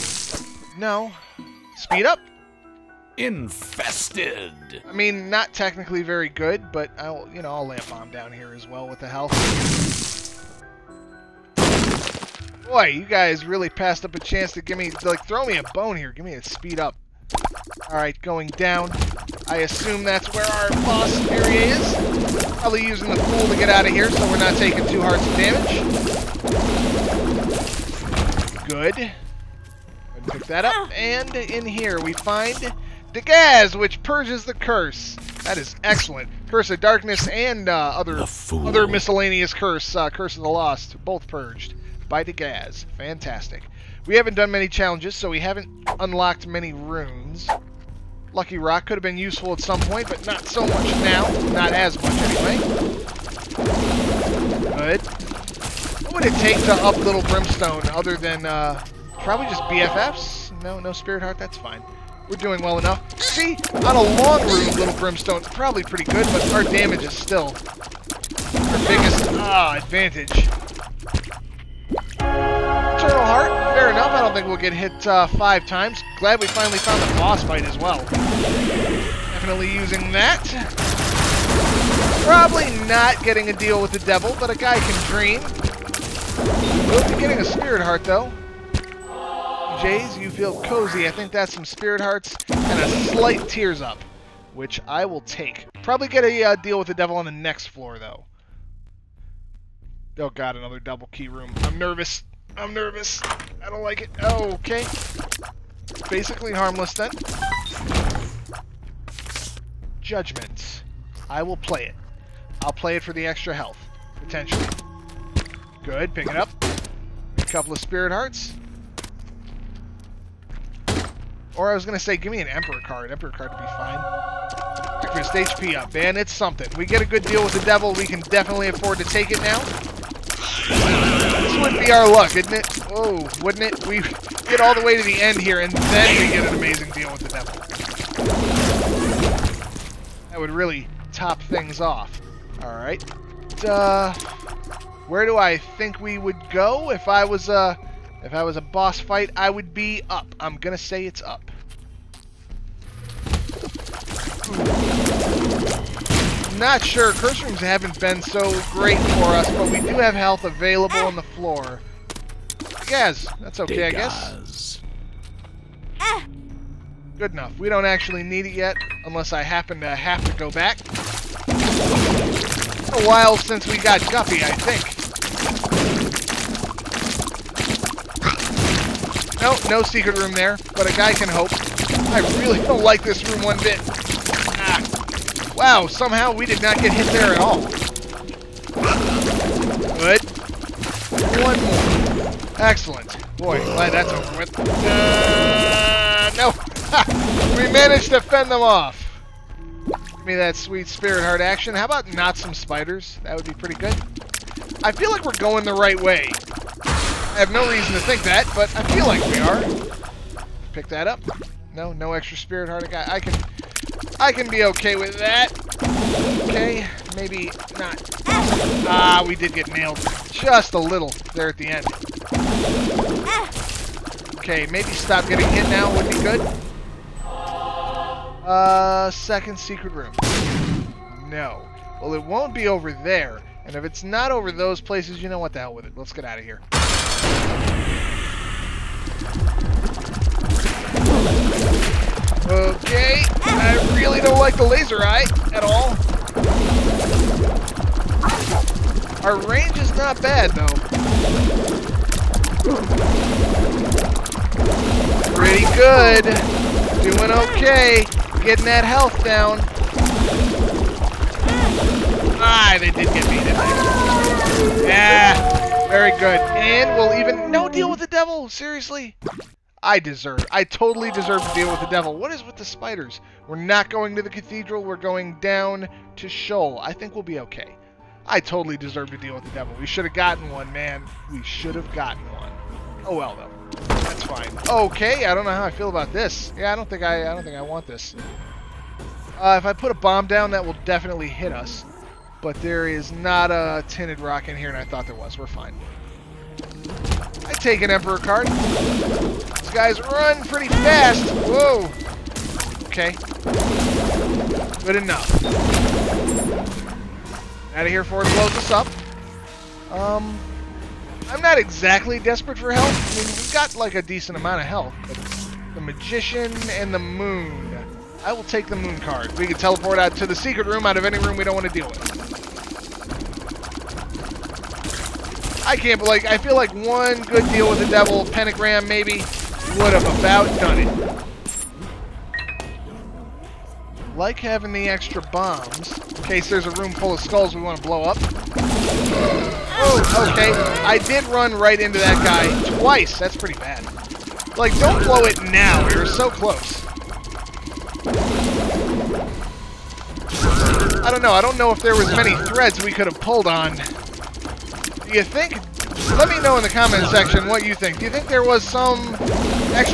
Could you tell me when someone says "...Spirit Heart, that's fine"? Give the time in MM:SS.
01:00.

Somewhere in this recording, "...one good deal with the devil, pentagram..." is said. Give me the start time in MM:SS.
05:26.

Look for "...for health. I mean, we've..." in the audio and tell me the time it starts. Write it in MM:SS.
05:12.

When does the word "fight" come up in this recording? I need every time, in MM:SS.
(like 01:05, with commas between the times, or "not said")
01:17, 02:28.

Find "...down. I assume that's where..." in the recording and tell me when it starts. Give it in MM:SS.
00:18.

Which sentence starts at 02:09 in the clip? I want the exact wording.
This would be our luck, isn't it?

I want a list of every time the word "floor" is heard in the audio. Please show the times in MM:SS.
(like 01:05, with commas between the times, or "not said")
01:37, 02:41.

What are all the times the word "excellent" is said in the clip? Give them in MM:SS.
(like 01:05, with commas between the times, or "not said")
00:35, 03:12.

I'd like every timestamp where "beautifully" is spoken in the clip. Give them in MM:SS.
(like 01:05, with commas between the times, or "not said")
not said.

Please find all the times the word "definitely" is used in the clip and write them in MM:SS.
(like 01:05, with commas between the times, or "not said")
01:18, 02:08, 04:50.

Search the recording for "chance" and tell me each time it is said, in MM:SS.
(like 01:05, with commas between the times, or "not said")
00:14.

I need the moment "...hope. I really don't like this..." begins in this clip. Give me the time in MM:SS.
03:01.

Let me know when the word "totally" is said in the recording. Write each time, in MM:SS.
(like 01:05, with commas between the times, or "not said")
04:30, 04:38.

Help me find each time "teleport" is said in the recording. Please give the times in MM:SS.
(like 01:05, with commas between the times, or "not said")
05:19.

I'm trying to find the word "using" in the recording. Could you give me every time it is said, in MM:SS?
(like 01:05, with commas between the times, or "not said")
00:22, 01:19.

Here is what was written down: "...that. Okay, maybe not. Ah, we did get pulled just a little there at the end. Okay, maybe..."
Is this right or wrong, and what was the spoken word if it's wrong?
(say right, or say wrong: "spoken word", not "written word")
wrong: "nailed", not "pulled".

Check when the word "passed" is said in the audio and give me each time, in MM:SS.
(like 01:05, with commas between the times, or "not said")
00:13.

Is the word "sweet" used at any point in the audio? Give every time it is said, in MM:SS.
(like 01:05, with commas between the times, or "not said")
03:20.